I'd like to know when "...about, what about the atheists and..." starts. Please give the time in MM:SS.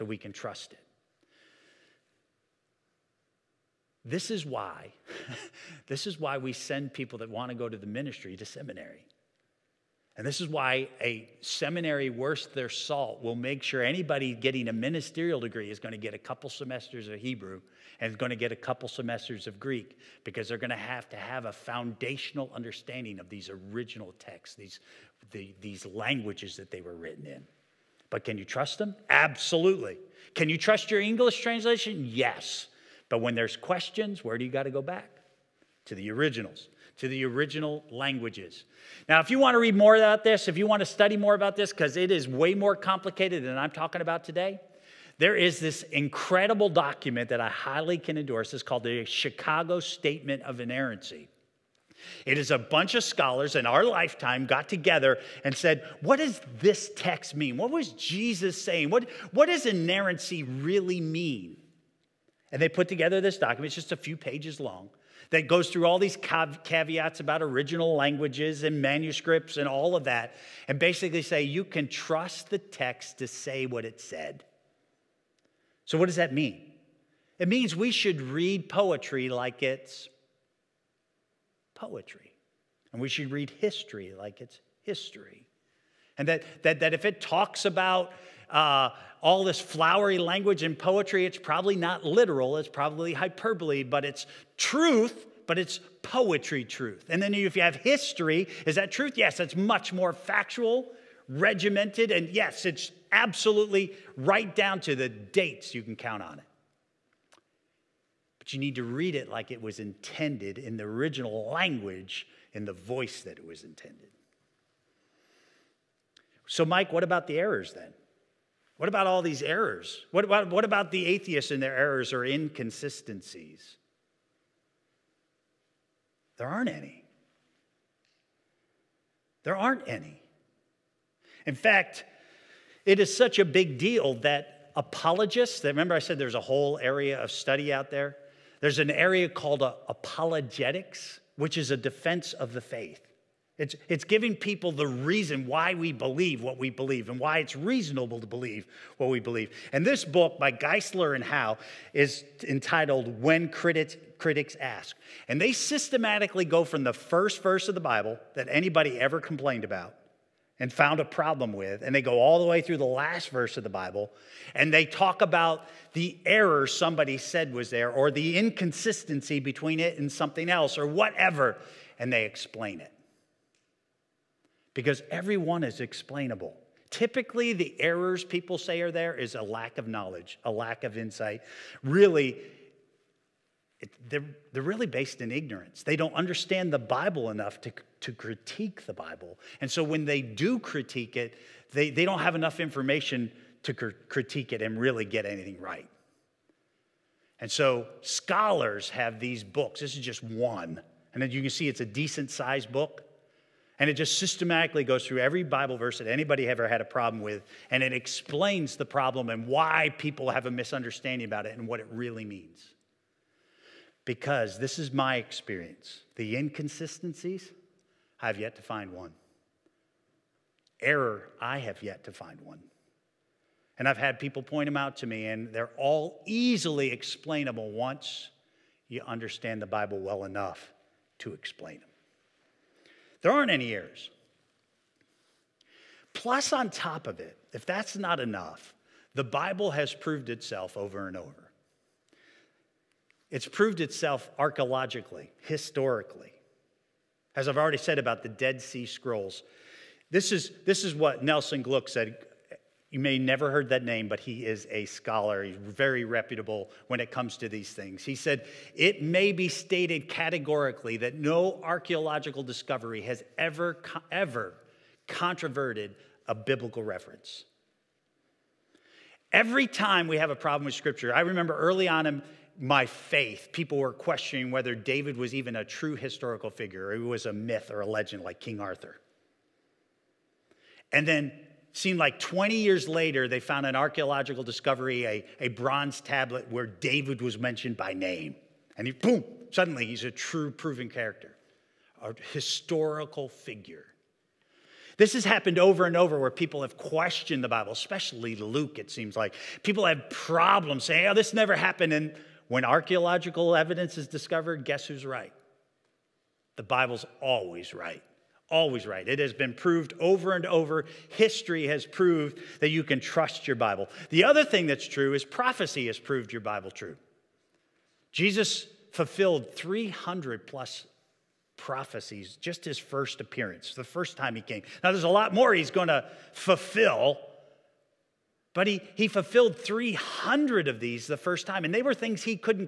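02:00.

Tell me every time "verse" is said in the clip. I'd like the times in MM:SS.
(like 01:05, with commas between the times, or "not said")
02:37, 02:43, 03:25.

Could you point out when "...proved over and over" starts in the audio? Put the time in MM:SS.
05:09.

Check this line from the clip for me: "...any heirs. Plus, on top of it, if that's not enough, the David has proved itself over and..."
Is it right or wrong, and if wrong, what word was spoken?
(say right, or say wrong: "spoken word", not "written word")
wrong: "Bible", not "David".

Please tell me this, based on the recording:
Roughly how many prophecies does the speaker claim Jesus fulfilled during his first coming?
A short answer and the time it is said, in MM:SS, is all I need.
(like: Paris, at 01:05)
300 plus, at 05:19.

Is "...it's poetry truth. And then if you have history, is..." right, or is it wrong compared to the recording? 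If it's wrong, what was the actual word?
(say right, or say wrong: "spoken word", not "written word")
right.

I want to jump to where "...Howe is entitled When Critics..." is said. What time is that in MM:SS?
02:31.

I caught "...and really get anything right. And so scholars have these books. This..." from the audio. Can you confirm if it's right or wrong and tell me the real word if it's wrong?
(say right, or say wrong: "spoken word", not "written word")
right.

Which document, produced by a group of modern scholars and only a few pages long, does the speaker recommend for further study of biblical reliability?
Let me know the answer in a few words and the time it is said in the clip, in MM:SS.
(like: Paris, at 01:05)
Chicago Statement of Inerrancy, at 00:49.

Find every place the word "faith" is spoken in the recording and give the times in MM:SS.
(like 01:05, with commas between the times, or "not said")
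02:22, 04:32.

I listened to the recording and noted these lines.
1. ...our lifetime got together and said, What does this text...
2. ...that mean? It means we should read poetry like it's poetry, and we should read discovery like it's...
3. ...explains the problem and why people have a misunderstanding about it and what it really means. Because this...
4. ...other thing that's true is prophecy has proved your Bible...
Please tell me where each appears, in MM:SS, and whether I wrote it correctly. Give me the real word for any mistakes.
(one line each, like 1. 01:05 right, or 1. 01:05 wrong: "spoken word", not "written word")
1. 00:53 right
2. 01:16 wrong: "history", not "discovery"
3. 03:27 right
4. 05:14 right.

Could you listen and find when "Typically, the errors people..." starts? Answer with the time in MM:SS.
02:56.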